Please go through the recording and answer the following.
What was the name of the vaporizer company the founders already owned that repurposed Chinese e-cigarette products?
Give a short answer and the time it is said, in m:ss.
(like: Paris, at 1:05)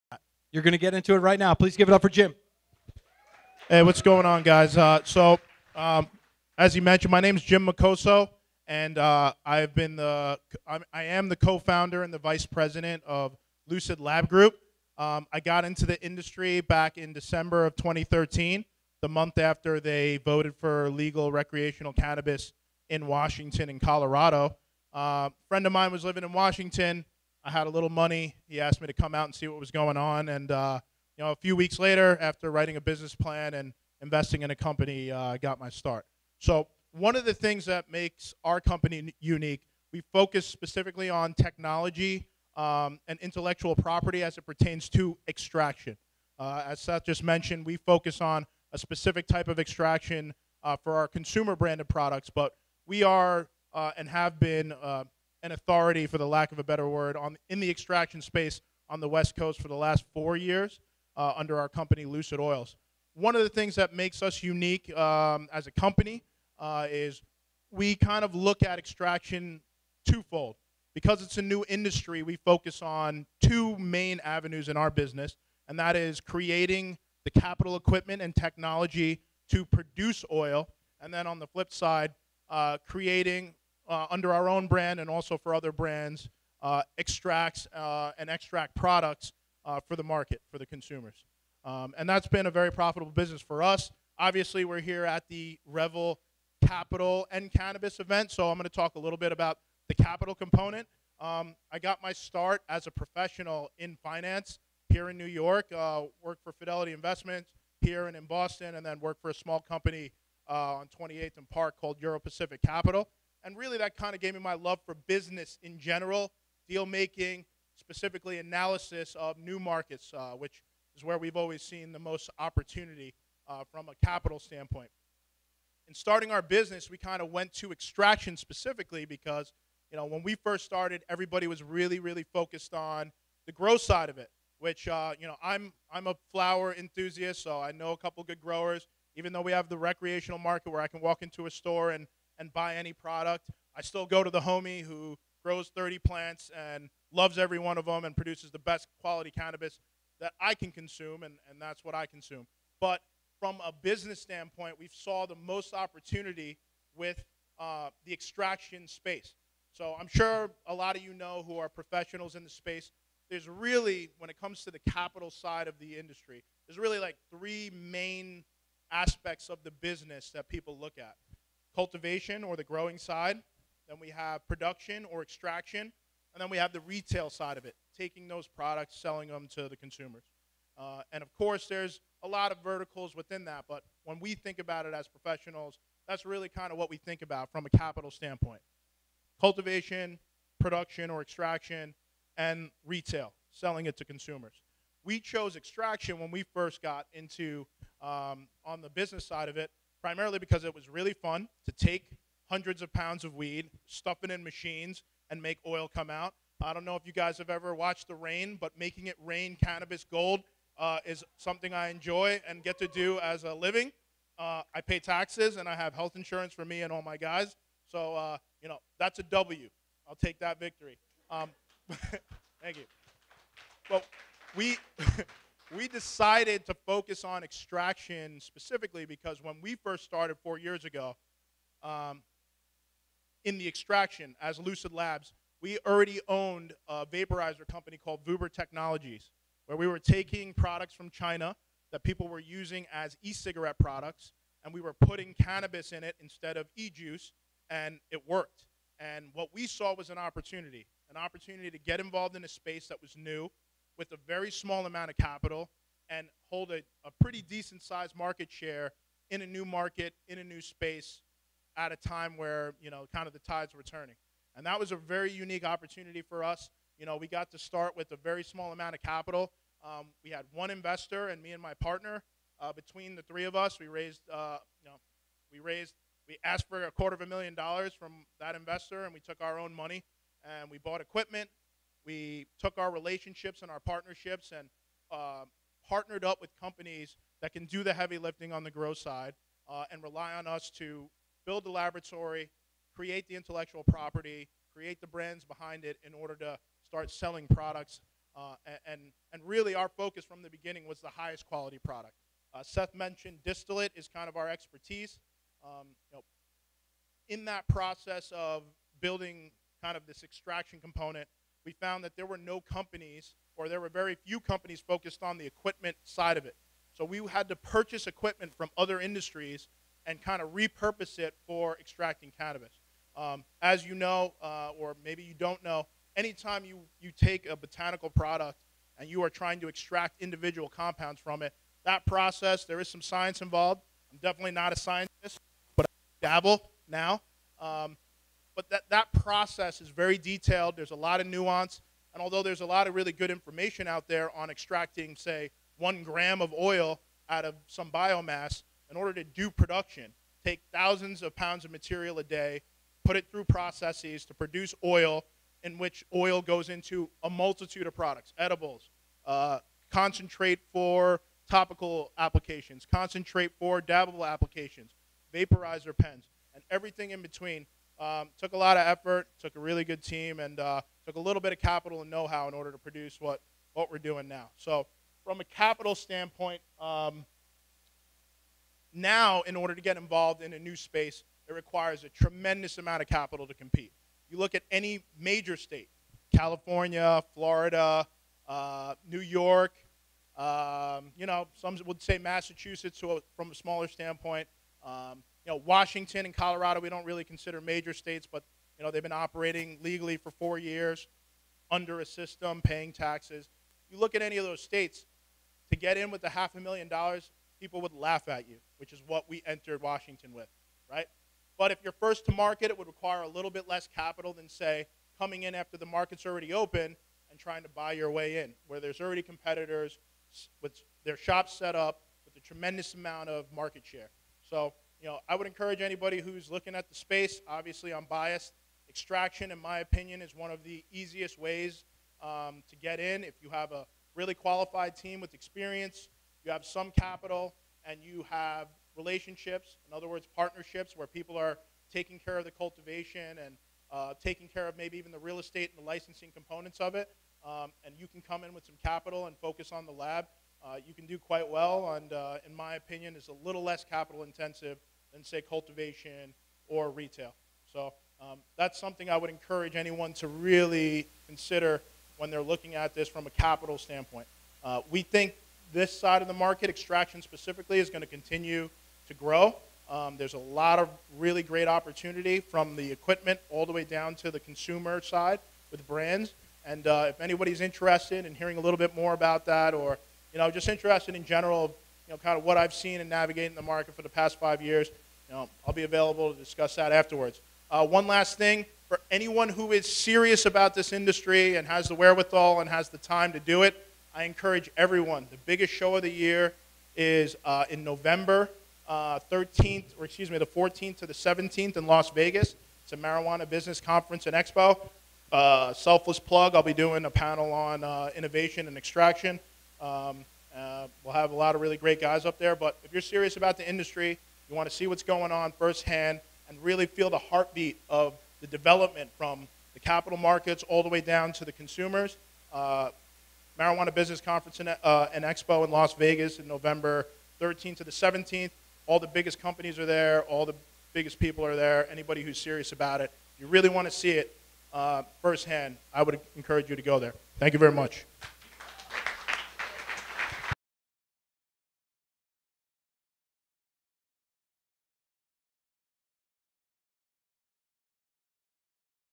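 Vuber Technologies, at 3:58.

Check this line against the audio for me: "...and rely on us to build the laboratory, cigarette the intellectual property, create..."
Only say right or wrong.
wrong.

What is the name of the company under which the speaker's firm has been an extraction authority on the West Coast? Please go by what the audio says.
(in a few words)
Lucid Oils.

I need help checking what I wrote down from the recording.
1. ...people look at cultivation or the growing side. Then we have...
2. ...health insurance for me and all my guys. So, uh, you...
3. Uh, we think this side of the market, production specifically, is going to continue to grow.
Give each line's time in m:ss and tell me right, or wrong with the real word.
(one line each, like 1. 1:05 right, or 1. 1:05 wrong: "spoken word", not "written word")
1. 2:50 right
2. 3:35 right
3. 7:44 wrong: "extraction", not "production".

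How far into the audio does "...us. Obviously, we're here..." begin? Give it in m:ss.
1:33.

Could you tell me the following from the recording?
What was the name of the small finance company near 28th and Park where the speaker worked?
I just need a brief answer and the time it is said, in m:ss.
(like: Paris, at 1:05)
Euro Pacific Capital, at 1:51.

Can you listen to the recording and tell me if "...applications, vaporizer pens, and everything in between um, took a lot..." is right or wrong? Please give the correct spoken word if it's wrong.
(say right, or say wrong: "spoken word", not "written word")
right.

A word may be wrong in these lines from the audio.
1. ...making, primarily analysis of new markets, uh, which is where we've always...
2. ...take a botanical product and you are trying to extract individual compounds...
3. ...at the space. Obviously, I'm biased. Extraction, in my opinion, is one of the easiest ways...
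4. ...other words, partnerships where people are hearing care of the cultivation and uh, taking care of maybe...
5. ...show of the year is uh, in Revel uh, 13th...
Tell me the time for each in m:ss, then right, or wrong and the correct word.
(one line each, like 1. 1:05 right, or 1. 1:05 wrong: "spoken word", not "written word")
1. 1:56 wrong: "specifically", not "primarily"
2. 5:27 right
3. 7:06 right
4. 7:19 wrong: "taking", not "hearing"
5. 8:15 wrong: "November", not "Revel".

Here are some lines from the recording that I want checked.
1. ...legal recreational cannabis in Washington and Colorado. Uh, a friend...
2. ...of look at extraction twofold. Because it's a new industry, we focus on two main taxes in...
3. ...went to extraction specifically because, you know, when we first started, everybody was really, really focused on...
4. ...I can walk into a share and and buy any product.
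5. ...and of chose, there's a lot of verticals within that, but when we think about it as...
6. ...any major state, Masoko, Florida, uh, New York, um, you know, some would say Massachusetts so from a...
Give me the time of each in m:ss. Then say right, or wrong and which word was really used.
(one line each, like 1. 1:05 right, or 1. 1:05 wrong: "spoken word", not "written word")
1. 0:20 right
2. 1:08 wrong: "avenues", not "taxes"
3. 2:07 right
4. 2:20 wrong: "store", not "share"
5. 3:01 wrong: "course", not "chose"
6. 6:24 wrong: "California", not "Masoko".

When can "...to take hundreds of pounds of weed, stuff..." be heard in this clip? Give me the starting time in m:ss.
3:21.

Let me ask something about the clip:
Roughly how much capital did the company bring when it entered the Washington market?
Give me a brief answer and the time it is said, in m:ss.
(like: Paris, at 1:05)
half a million dollars, at 6:46.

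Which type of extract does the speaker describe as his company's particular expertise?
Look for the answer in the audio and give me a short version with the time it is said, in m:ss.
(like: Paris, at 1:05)
distillate, at 5:03.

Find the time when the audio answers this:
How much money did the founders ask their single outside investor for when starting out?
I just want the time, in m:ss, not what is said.
4:36.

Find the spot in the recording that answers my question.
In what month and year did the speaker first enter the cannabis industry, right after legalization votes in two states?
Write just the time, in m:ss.
0:17.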